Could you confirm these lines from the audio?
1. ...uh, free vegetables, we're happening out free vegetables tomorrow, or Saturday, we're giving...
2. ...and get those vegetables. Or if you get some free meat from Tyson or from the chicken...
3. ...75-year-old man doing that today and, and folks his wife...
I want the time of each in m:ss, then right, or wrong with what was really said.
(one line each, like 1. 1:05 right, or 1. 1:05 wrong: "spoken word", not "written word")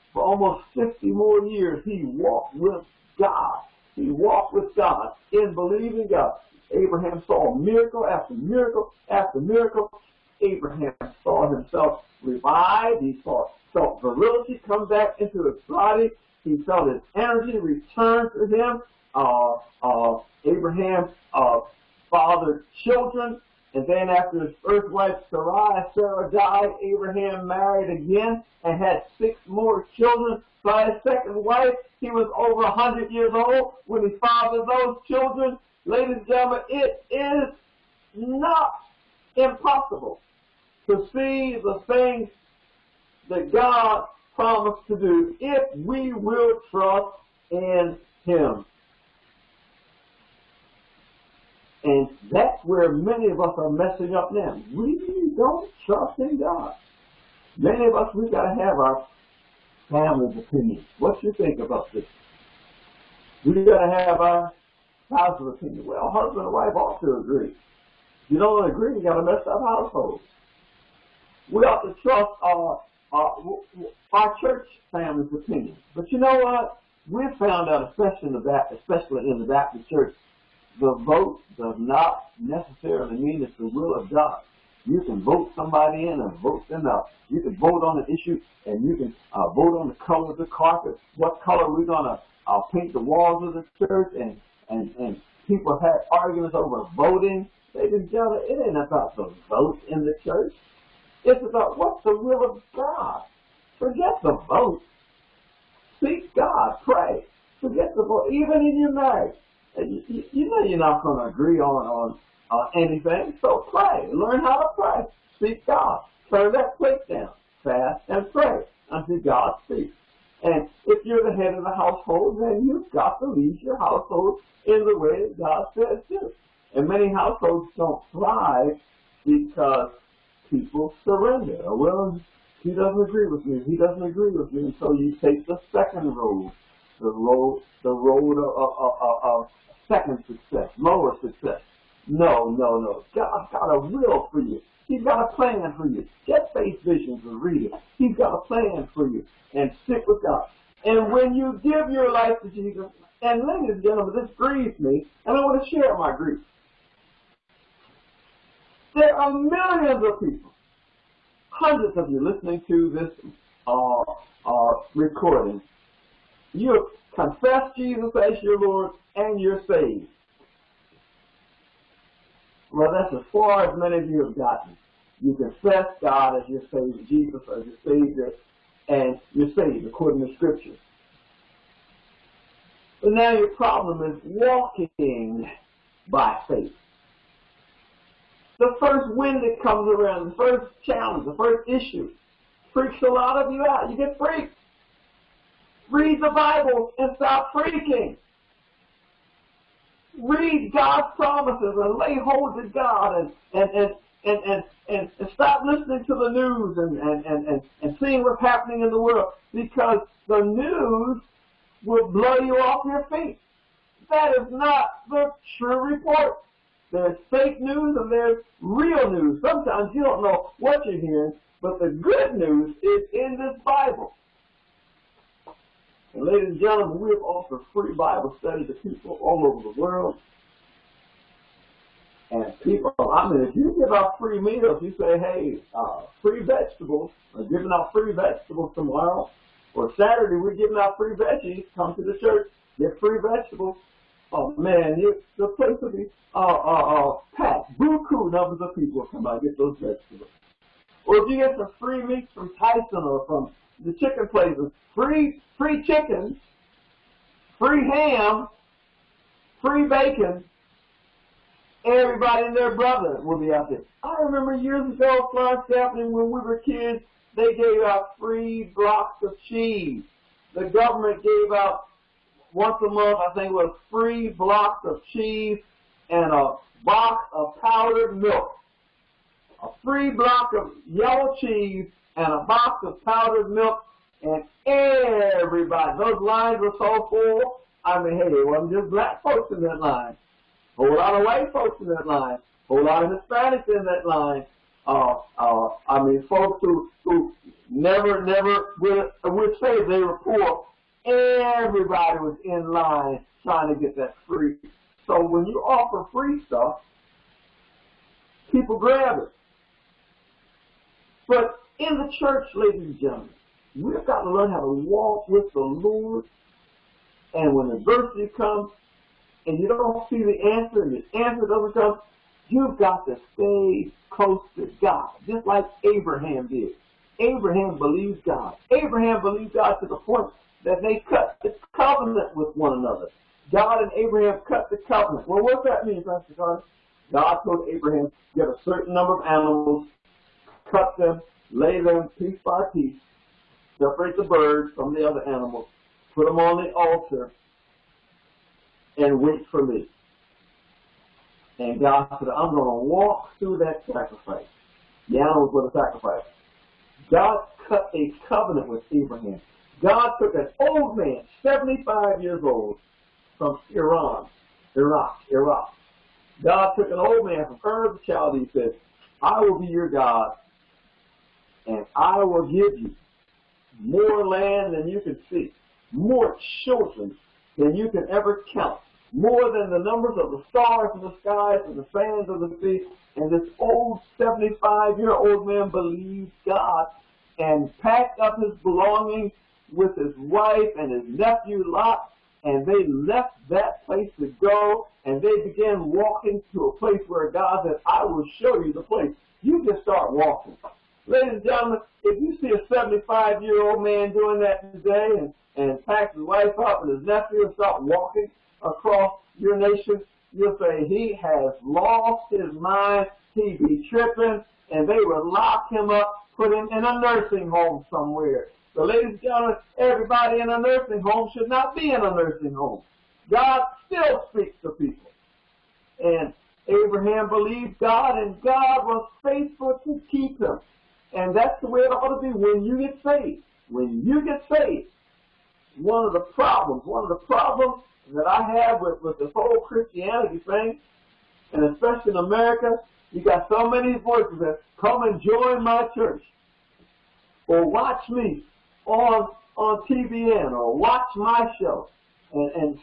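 1. 3:55 wrong: "giving", not "happening"
2. 4:09 right
3. 6:42 wrong: "packs", not "folks".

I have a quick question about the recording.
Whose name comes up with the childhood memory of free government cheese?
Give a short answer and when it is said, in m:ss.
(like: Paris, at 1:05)
Florence Chaplain, at 4:25.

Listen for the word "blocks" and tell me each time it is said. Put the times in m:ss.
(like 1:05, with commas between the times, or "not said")
4:28, 4:34, 4:40.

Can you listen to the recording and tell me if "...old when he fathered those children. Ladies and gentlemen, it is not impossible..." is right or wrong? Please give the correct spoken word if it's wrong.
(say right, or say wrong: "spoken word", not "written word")
right.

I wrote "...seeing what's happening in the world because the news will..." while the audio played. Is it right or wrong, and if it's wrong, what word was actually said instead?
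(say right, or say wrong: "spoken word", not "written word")
right.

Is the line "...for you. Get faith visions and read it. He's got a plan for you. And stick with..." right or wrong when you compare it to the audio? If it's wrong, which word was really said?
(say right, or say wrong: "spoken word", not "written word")
right.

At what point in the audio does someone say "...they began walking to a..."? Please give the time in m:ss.
6:35.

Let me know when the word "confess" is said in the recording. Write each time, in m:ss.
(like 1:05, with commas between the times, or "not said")
2:47, 2:55.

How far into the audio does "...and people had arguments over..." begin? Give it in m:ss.
1:34.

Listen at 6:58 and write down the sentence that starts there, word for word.
So ladies and gentlemen, everybody in a nursing home should not be in a nursing home.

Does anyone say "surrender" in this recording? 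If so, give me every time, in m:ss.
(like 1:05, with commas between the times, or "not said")
2:11.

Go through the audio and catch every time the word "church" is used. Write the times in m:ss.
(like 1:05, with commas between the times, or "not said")
1:14, 1:19, 1:33, 1:40, 4:02, 5:12, 7:25.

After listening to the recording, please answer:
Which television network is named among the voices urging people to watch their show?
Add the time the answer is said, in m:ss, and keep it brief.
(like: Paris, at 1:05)
TBN, at 7:29.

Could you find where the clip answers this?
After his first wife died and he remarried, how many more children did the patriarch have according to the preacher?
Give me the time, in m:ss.
0:29.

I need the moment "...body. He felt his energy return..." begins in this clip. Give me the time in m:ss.
0:15.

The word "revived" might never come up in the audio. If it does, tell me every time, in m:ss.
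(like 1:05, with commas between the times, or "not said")
0:12.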